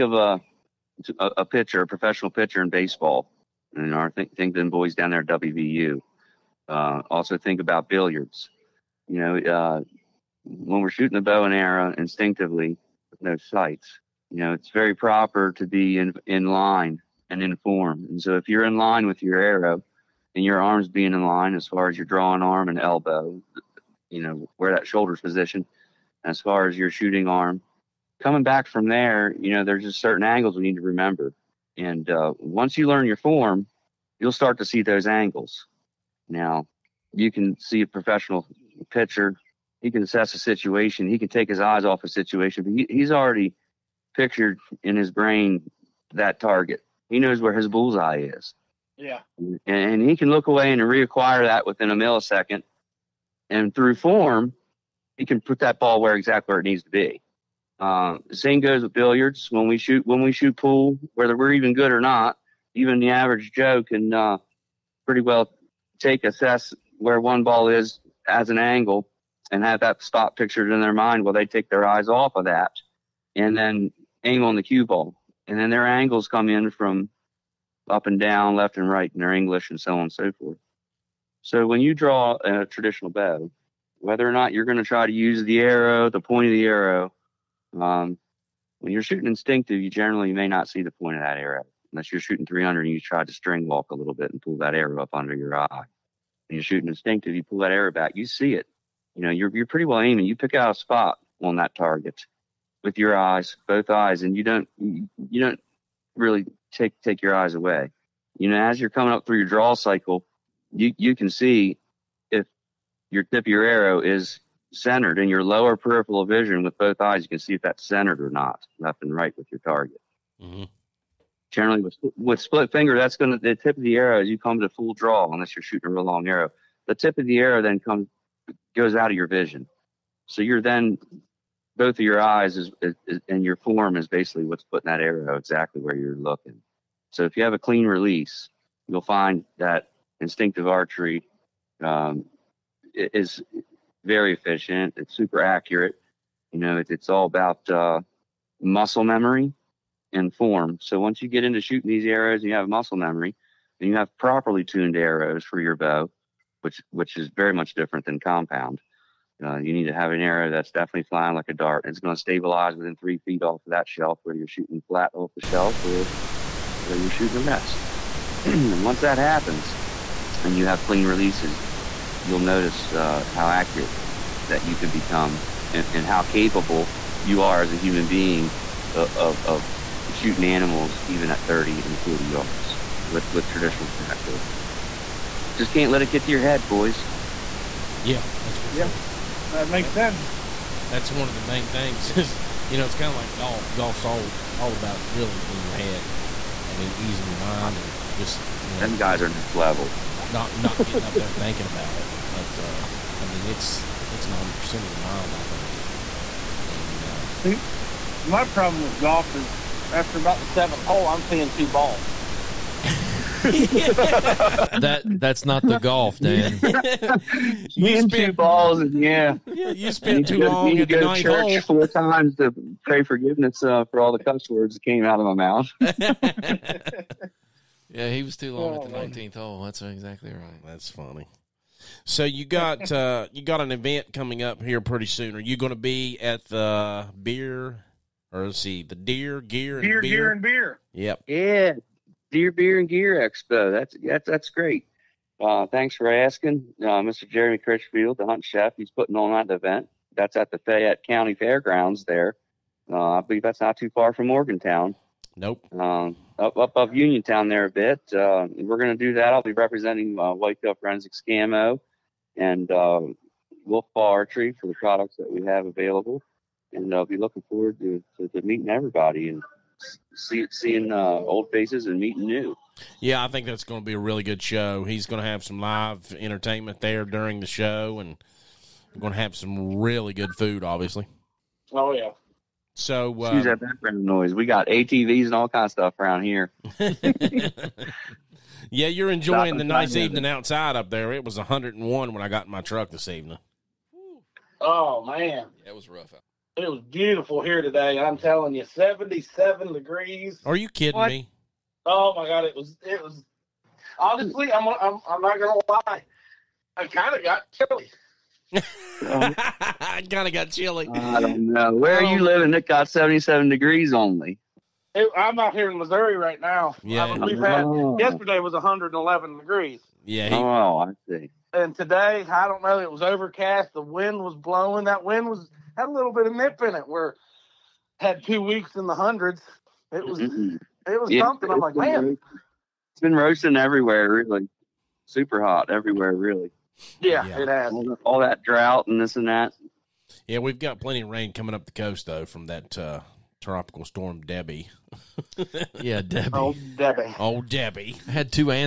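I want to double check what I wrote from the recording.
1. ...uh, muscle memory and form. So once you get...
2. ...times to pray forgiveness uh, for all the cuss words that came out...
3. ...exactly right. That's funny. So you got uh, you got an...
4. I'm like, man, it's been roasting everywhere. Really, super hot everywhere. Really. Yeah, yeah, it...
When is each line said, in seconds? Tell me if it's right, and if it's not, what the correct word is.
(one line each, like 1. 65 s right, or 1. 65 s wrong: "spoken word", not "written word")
1. 147 s right
2. 221 s right
3. 229 s right
4. 331 s right.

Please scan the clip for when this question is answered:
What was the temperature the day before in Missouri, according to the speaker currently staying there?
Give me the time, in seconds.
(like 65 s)
318 s.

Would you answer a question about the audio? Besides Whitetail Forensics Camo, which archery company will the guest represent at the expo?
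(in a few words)
Wolf Paw Archery.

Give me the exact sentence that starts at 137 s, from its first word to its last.
So if you have a clean release, you'll find that instinctive archery um, is very efficient.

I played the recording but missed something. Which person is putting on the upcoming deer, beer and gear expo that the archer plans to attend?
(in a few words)
Jeremy Critchfield.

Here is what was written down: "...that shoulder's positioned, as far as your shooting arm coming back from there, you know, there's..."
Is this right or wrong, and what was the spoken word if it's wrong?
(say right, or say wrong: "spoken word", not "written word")
right.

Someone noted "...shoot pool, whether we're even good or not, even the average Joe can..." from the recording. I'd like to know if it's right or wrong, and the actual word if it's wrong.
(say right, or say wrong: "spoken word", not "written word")
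right.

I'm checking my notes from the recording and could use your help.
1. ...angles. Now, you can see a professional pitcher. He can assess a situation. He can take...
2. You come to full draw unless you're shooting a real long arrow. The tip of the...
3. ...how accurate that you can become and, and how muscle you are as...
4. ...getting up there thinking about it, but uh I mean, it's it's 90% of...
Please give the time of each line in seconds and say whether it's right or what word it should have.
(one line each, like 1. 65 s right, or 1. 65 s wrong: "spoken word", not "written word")
1. 35 s right
2. 124 s right
3. 173 s wrong: "capable", not "muscle"
4. 200 s right.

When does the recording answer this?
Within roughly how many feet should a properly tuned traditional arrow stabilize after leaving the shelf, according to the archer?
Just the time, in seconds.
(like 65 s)
162 s.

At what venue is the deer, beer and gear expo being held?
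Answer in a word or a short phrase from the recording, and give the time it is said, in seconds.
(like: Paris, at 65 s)
Fayette County Fairgrounds, at 250 s.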